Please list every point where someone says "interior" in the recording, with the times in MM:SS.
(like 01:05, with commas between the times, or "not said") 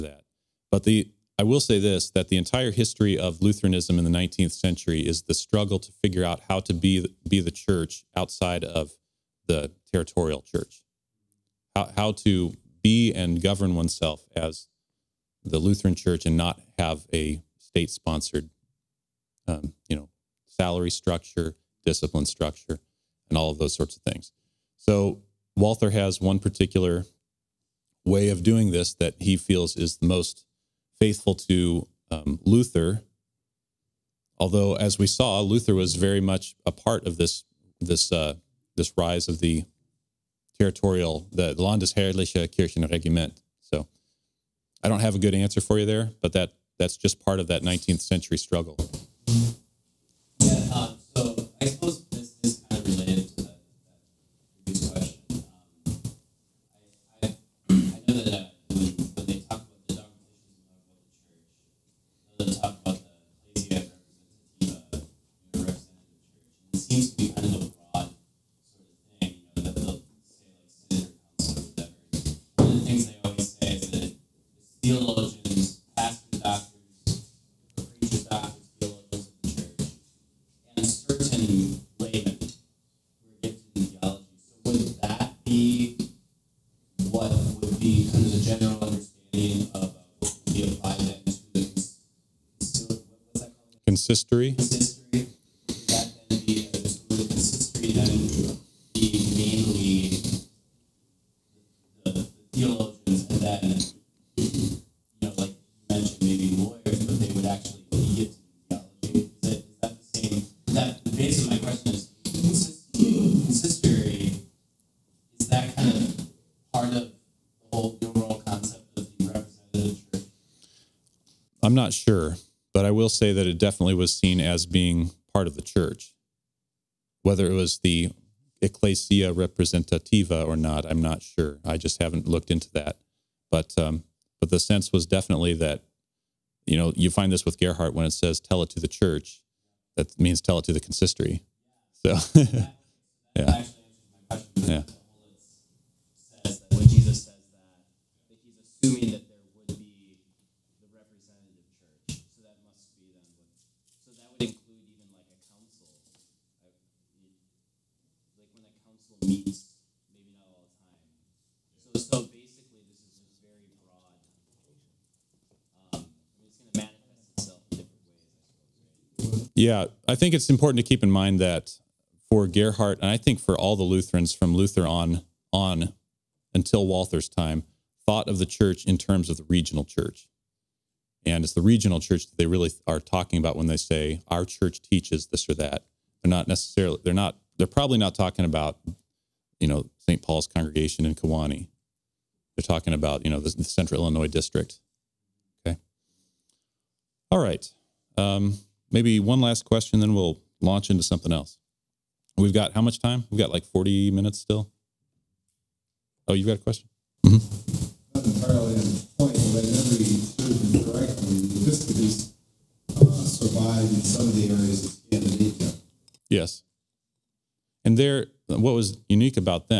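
not said.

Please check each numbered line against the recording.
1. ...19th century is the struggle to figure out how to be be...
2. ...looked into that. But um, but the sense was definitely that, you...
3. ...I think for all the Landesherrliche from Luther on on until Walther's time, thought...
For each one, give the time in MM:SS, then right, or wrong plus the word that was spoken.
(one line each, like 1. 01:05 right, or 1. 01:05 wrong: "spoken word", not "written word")
1. 00:04 right
2. 02:12 right
3. 02:53 wrong: "Lutherans", not "Landesherrliche".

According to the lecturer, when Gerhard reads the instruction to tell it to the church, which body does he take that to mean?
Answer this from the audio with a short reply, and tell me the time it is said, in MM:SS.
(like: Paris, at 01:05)
the consistory, at 02:20.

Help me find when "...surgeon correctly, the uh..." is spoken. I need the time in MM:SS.
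03:30.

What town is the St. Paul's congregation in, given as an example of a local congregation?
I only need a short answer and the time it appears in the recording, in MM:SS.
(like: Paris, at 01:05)
Kewanee, at 03:11.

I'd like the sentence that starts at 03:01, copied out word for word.
And it's the regional church that they really are talking about when they say our church teaches this or that.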